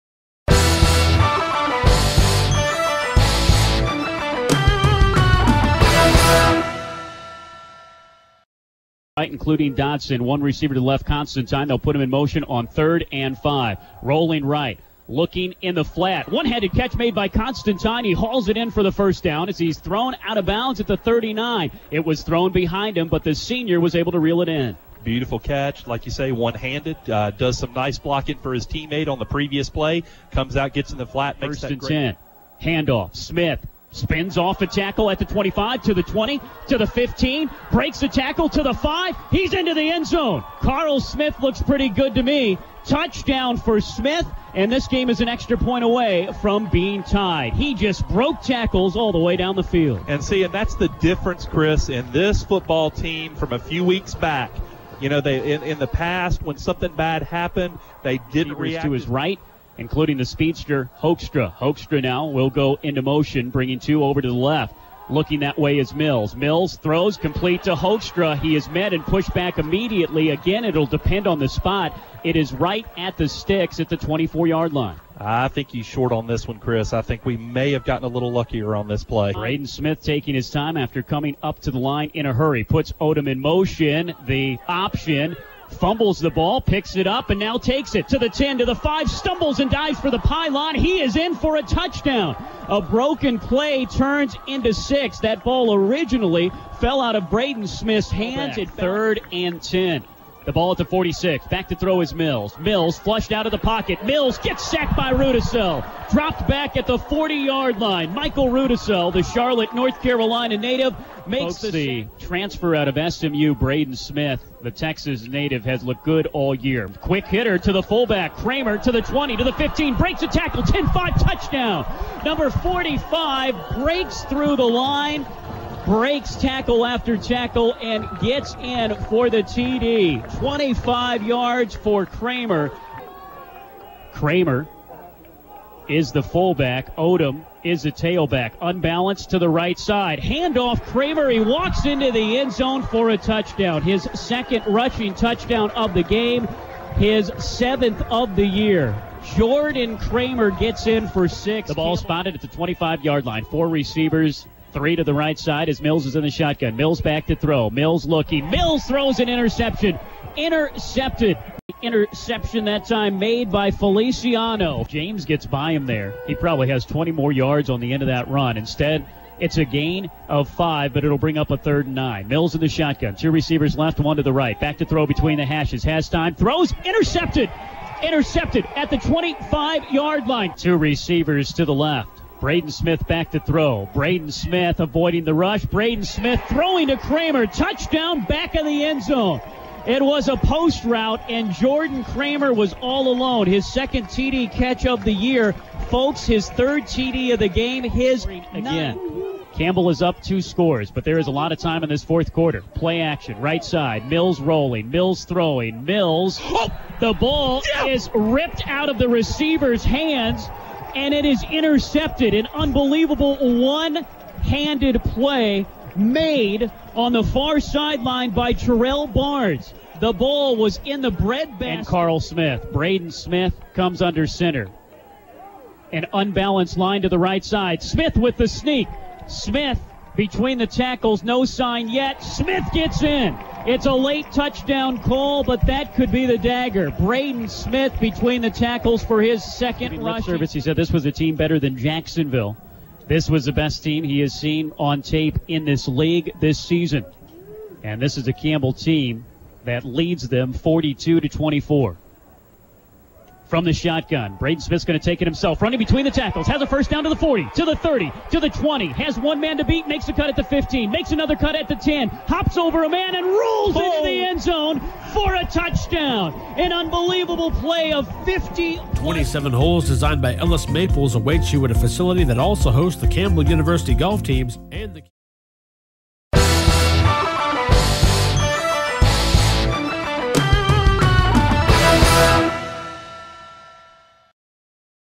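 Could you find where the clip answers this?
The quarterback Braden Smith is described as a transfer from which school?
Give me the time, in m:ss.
1:53.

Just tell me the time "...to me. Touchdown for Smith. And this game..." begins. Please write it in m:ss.
0:42.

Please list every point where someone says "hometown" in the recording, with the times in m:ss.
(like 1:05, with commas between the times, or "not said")
not said.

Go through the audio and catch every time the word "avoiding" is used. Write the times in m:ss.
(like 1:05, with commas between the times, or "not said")
3:04.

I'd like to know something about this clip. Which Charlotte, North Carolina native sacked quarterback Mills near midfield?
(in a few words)
Michael Rudisell.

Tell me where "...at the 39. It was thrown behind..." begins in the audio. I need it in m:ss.
0:20.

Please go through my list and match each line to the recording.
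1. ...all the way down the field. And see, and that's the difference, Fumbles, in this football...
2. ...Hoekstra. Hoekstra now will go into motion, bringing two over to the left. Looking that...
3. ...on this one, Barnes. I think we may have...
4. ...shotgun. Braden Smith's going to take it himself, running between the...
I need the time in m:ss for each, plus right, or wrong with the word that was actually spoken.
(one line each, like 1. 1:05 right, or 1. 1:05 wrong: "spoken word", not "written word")
1. 0:48 wrong: "Chris", not "Fumbles"
2. 1:00 right
3. 1:16 wrong: "Chris", not "Barnes"
4. 4:13 right.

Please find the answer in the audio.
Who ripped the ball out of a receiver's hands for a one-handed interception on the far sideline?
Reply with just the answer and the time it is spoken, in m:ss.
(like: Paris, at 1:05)
Terrell Barnes, at 3:38.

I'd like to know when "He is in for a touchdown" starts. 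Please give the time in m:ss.
1:30.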